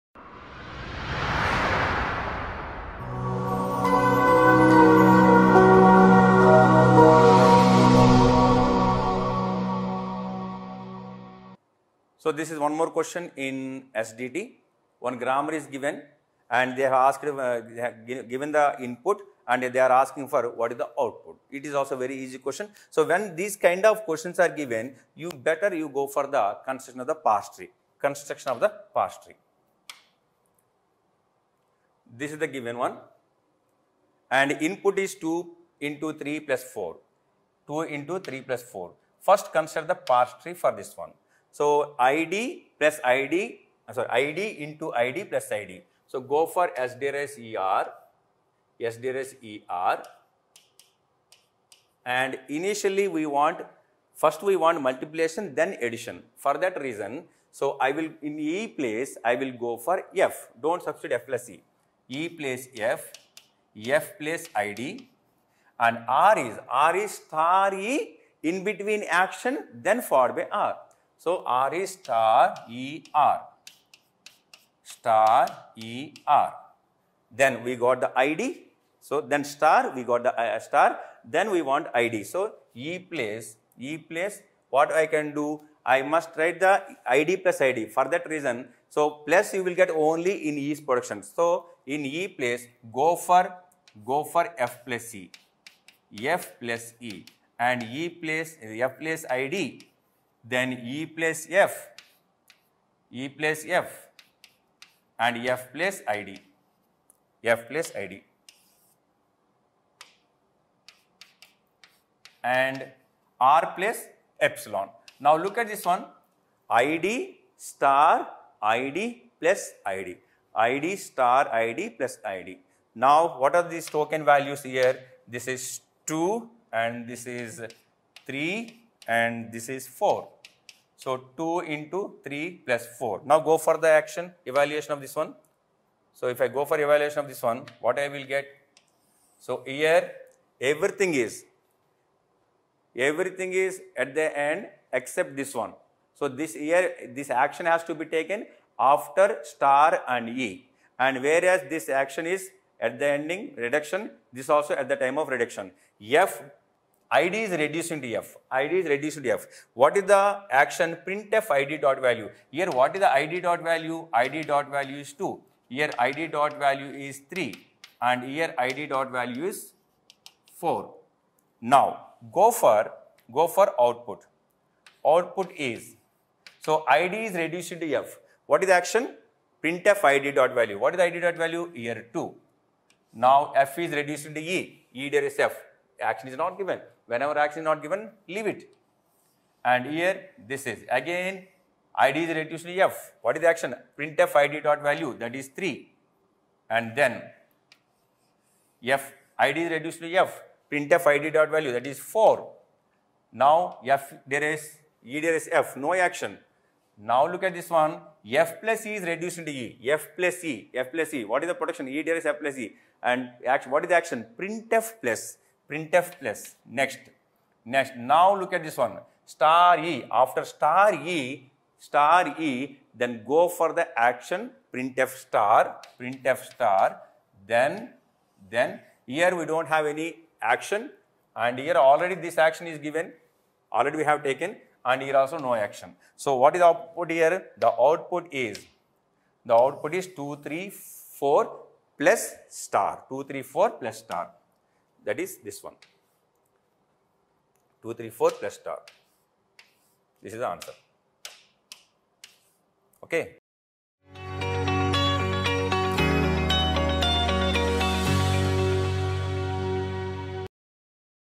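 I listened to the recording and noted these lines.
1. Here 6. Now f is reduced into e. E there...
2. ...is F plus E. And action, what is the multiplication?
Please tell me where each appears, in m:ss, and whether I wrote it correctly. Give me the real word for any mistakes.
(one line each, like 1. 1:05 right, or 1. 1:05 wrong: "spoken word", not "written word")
1. 3:01 wrong: "2", not "6"
2. 3:32 wrong: "action", not "multiplication".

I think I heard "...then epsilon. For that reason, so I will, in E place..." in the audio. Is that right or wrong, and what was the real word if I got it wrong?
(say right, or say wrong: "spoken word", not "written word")
wrong: "addition", not "epsilon".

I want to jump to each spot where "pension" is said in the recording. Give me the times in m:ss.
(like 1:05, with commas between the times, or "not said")
not said.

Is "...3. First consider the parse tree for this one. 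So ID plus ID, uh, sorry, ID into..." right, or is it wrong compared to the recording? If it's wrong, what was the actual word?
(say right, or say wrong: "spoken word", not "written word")
wrong: "4", not "3".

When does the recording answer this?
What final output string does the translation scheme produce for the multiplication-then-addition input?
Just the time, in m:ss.
4:07.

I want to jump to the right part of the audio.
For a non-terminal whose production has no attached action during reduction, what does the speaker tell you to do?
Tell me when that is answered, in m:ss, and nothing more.
3:08.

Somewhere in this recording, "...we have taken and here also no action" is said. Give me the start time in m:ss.
3:53.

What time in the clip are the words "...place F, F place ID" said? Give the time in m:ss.
1:02.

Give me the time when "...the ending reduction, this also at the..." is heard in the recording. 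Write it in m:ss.
2:32.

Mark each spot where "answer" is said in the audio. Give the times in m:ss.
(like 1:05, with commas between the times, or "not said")
4:10.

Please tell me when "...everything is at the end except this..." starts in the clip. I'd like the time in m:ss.
2:22.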